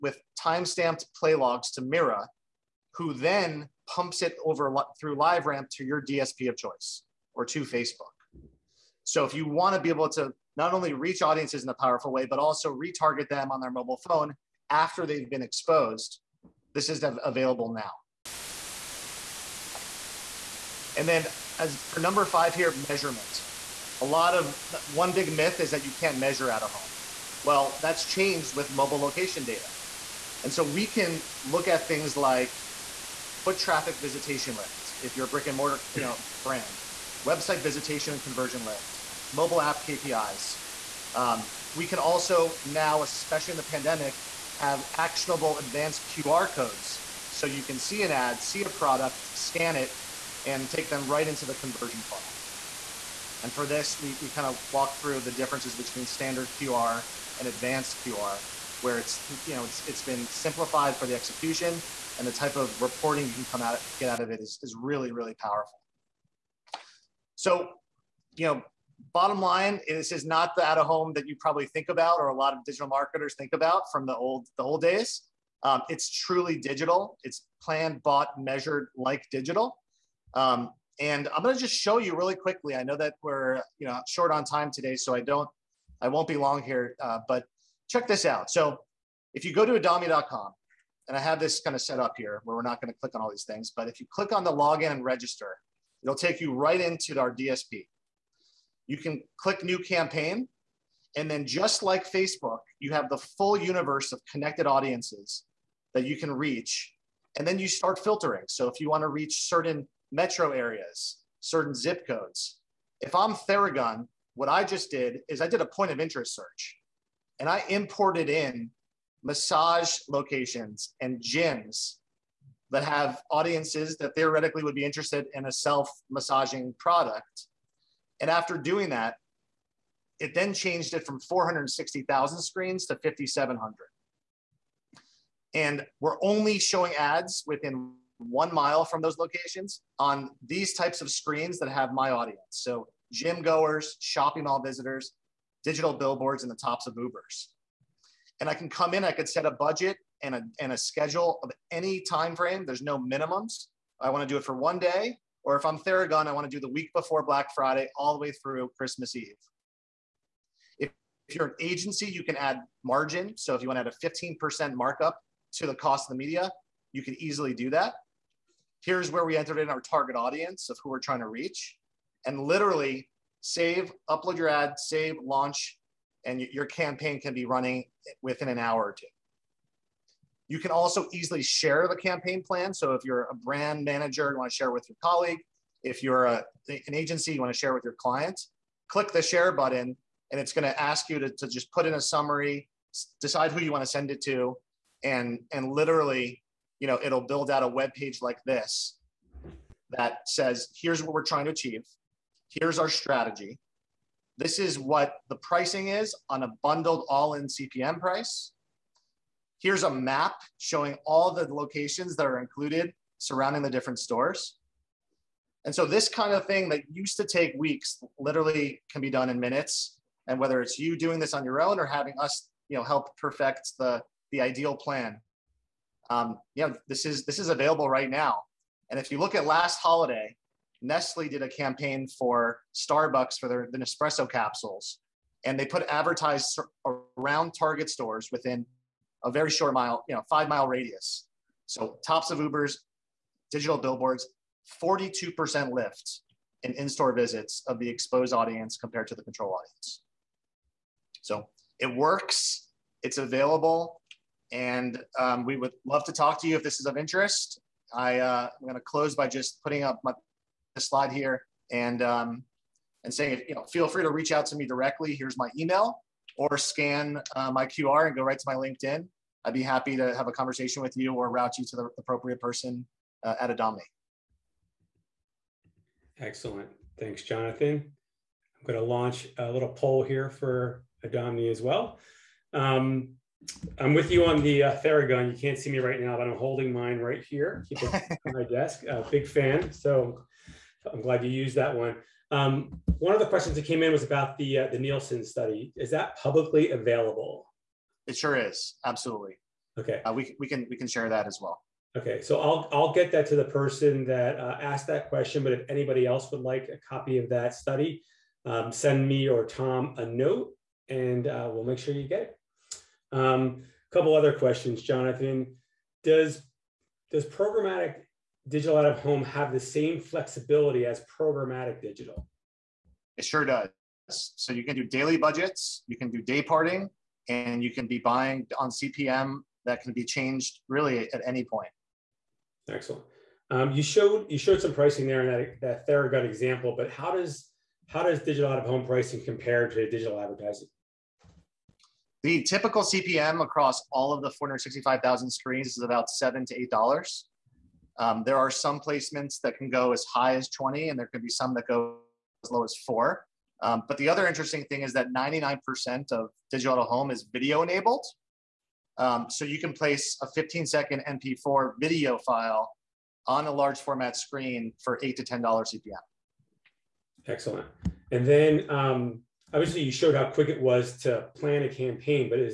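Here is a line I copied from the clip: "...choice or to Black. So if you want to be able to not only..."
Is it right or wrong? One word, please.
wrong.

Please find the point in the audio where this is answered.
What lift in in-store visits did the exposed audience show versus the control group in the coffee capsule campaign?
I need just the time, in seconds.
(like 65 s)
244 s.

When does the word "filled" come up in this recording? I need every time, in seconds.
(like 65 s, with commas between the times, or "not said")
not said.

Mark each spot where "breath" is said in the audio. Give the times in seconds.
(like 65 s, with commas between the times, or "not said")
not said.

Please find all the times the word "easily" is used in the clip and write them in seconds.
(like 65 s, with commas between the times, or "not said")
167 s, 181 s.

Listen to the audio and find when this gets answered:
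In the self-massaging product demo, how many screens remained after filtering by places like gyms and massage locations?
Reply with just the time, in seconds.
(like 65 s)
133 s.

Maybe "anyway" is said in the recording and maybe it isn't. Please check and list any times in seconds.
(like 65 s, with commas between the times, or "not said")
not said.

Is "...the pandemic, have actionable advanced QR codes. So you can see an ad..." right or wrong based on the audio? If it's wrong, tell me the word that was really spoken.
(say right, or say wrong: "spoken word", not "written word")
right.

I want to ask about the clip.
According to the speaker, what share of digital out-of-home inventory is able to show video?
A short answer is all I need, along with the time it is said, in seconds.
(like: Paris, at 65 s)
99%, at 355 s.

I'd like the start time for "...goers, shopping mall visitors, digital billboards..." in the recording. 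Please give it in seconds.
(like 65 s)
143 s.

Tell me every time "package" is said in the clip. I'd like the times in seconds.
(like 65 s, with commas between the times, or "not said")
not said.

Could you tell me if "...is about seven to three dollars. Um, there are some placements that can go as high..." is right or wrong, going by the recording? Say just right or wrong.
wrong.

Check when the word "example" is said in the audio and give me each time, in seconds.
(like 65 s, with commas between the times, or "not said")
336 s.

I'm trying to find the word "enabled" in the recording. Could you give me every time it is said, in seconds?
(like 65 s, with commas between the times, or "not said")
357 s.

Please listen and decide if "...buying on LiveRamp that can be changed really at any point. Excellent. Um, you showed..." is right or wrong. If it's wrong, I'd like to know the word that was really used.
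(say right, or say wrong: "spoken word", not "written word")
wrong: "CPM", not "LiveRamp".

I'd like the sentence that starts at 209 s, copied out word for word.
Here's a map showing all the locations that are included surrounding the different stores.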